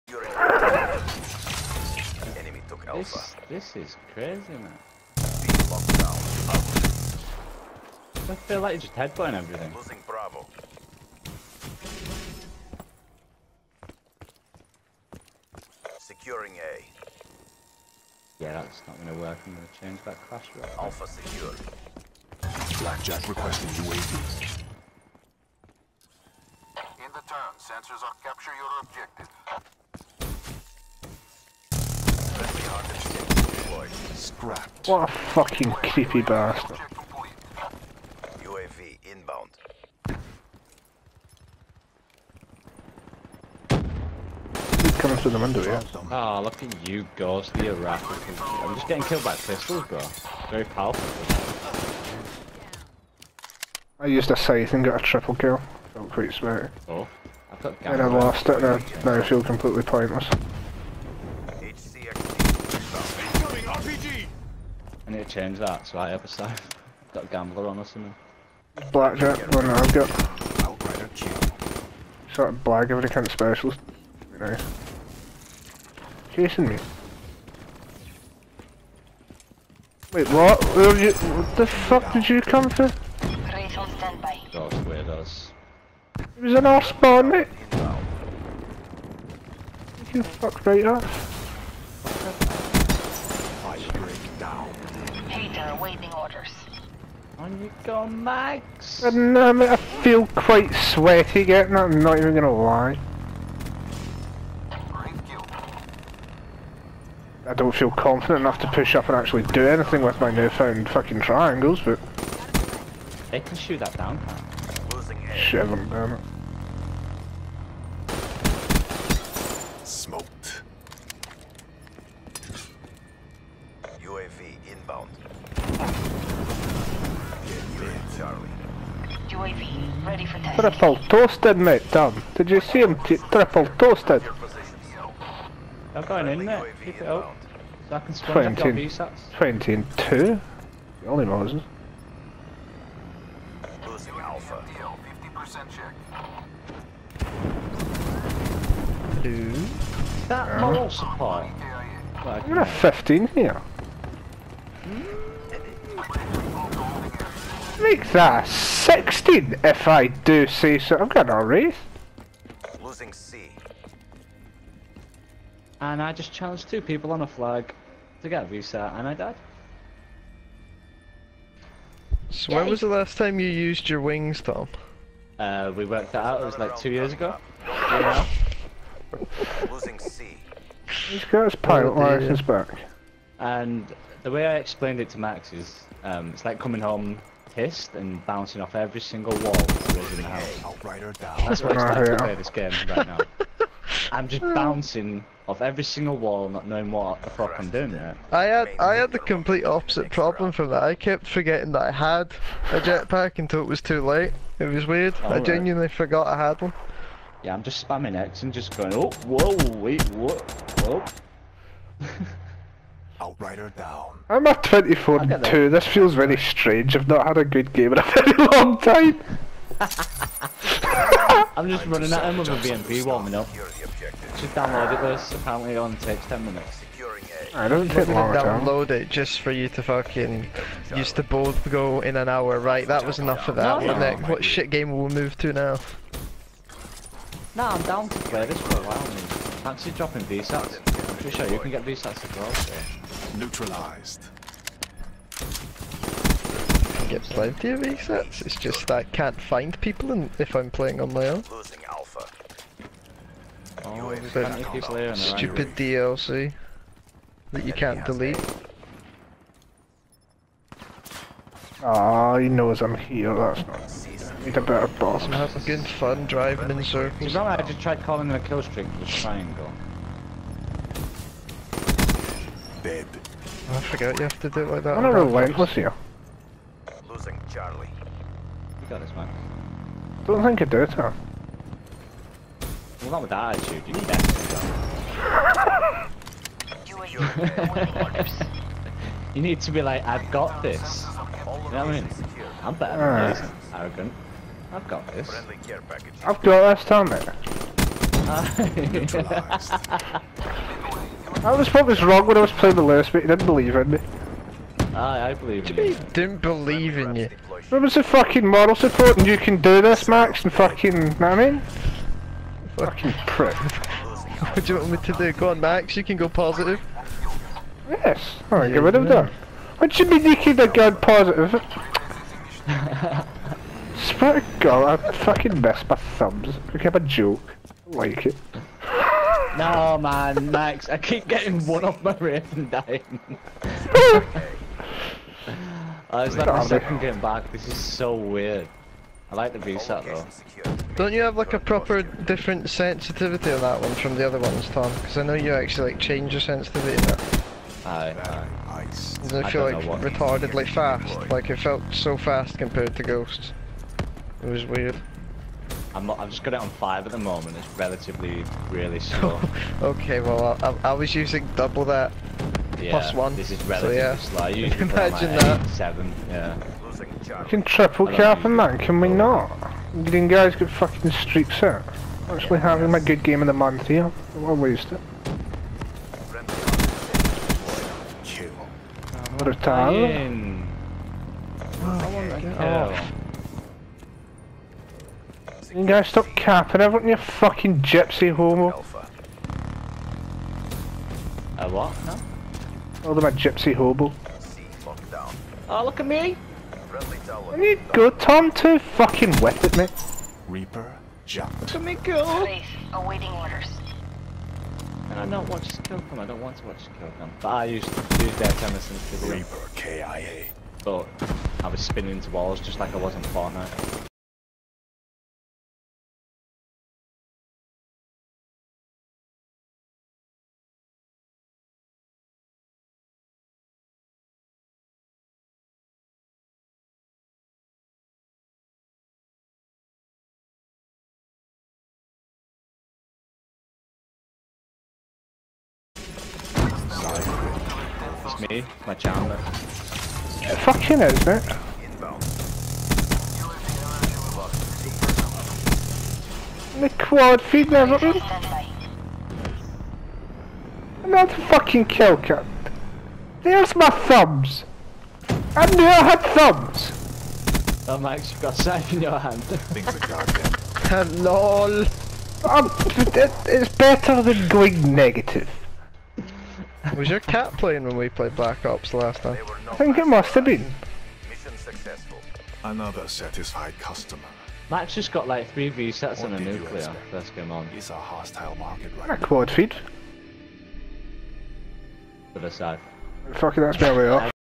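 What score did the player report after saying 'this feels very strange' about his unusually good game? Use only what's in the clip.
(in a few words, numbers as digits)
24 and 2.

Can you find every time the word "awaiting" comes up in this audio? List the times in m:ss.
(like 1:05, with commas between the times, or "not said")
1:35, 6:42.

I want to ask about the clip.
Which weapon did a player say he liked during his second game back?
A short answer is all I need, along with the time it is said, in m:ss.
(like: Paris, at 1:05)
VSAT, at 5:39.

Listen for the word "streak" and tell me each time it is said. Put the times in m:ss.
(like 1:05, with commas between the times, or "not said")
4:28, 6:11.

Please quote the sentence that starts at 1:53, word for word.
They can shoot that down, Losing Shit, I'm down it.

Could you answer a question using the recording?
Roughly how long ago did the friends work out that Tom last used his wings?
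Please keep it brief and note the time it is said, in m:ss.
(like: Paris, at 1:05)
2 years, at 2:56.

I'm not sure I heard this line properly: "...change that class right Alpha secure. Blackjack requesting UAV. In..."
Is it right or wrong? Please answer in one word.
right.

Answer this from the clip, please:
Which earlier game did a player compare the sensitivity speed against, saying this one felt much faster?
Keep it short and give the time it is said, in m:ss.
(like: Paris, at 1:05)
Ghosts, at 5:53.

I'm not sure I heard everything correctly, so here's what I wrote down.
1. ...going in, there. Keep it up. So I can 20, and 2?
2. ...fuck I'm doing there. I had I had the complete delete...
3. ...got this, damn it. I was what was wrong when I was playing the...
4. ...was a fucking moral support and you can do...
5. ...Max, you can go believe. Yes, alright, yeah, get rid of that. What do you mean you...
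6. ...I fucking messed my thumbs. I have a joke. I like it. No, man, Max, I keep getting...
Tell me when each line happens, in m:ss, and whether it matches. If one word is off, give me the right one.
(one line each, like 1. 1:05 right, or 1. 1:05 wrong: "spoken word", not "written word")
1. 2:16 right
2. 3:17 wrong: "opposite", not "delete"
3. 4:56 right
4. 5:07 right
5. 5:15 wrong: "positive", not "believe"
6. 5:25 right.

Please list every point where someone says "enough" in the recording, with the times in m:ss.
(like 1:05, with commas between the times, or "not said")
1:48, 3:53.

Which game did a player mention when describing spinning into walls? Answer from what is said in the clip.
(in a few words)
Fortnite.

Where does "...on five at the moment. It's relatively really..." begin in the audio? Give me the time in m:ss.
5:56.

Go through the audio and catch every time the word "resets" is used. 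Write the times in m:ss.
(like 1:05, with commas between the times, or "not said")
4:01, 4:07, 7:55.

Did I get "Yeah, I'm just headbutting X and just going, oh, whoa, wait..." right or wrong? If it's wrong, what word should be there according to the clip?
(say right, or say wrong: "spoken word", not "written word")
wrong: "spamming", not "headbutting".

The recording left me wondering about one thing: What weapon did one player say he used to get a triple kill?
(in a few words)
Scythe.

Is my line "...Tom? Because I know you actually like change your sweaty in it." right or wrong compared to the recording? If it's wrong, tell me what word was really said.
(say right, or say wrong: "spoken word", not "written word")
wrong: "sensitivity", not "sweaty".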